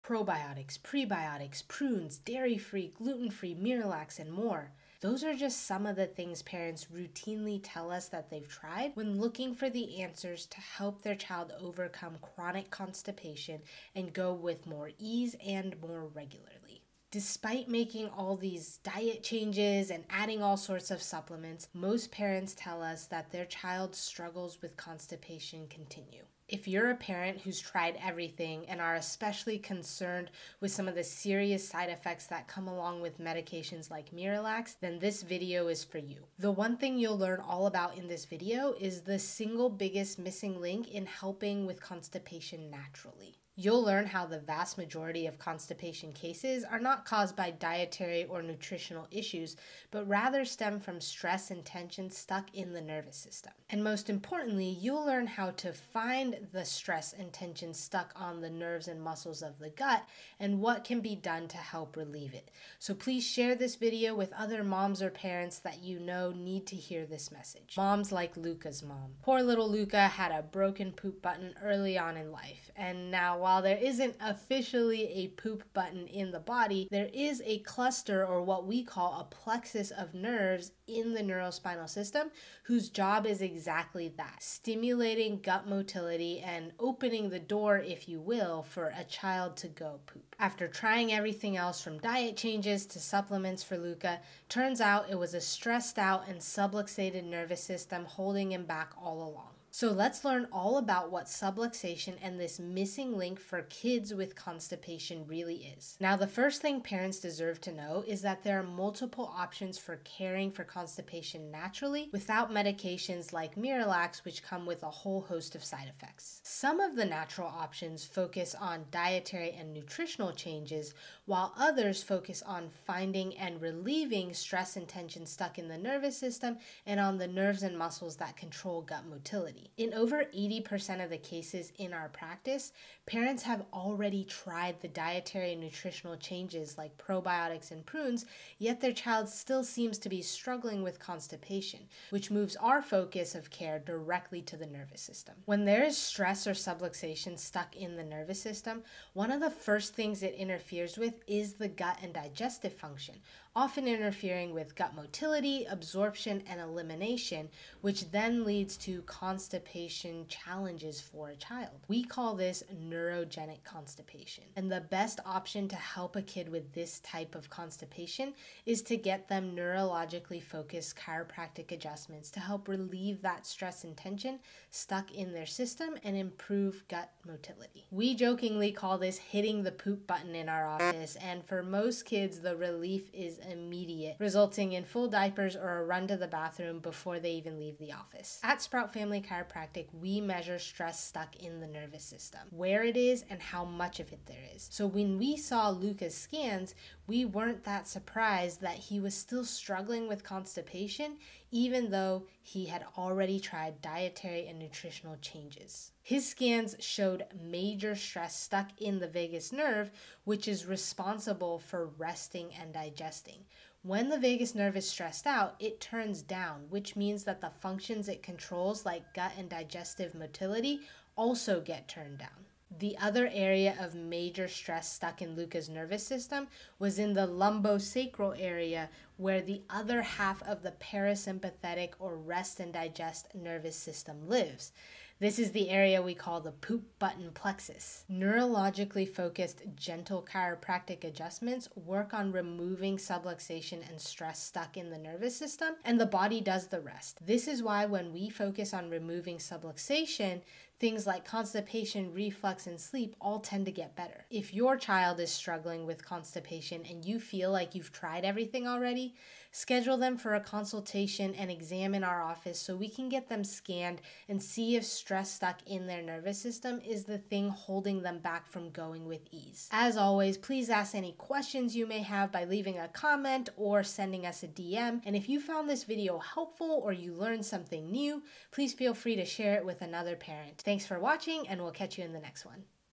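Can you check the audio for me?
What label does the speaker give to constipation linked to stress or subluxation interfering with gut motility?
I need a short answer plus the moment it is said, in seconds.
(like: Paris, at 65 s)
Neurogenic constipation, at 162 s.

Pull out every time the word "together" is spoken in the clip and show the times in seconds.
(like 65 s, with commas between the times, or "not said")
not said.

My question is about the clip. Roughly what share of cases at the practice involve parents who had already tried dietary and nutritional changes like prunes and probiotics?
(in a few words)
Over 80%.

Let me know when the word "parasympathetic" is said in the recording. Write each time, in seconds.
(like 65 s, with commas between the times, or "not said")
230 s.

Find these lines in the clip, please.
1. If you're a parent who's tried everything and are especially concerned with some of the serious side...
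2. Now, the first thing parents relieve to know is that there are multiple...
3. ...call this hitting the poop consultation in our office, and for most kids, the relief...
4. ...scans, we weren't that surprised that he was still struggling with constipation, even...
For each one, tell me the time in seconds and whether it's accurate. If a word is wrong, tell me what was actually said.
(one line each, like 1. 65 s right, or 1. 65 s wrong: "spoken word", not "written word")
1. 26 s right
2. 105 s wrong: "deserve", not "relieve"
3. 178 s wrong: "button", not "consultation"
4. 196 s right.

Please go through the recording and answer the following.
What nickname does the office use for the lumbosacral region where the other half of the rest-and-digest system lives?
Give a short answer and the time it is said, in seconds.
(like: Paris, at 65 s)
Poop button plexus, at 236 s.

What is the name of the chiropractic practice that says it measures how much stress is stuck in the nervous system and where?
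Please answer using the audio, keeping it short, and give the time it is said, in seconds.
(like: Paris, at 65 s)
Sprout Family Chiropractic, at 188 s.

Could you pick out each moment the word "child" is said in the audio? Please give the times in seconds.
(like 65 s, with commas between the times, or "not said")
11 s, 23 s, 89 s, 138 s, 161 s, 254 s.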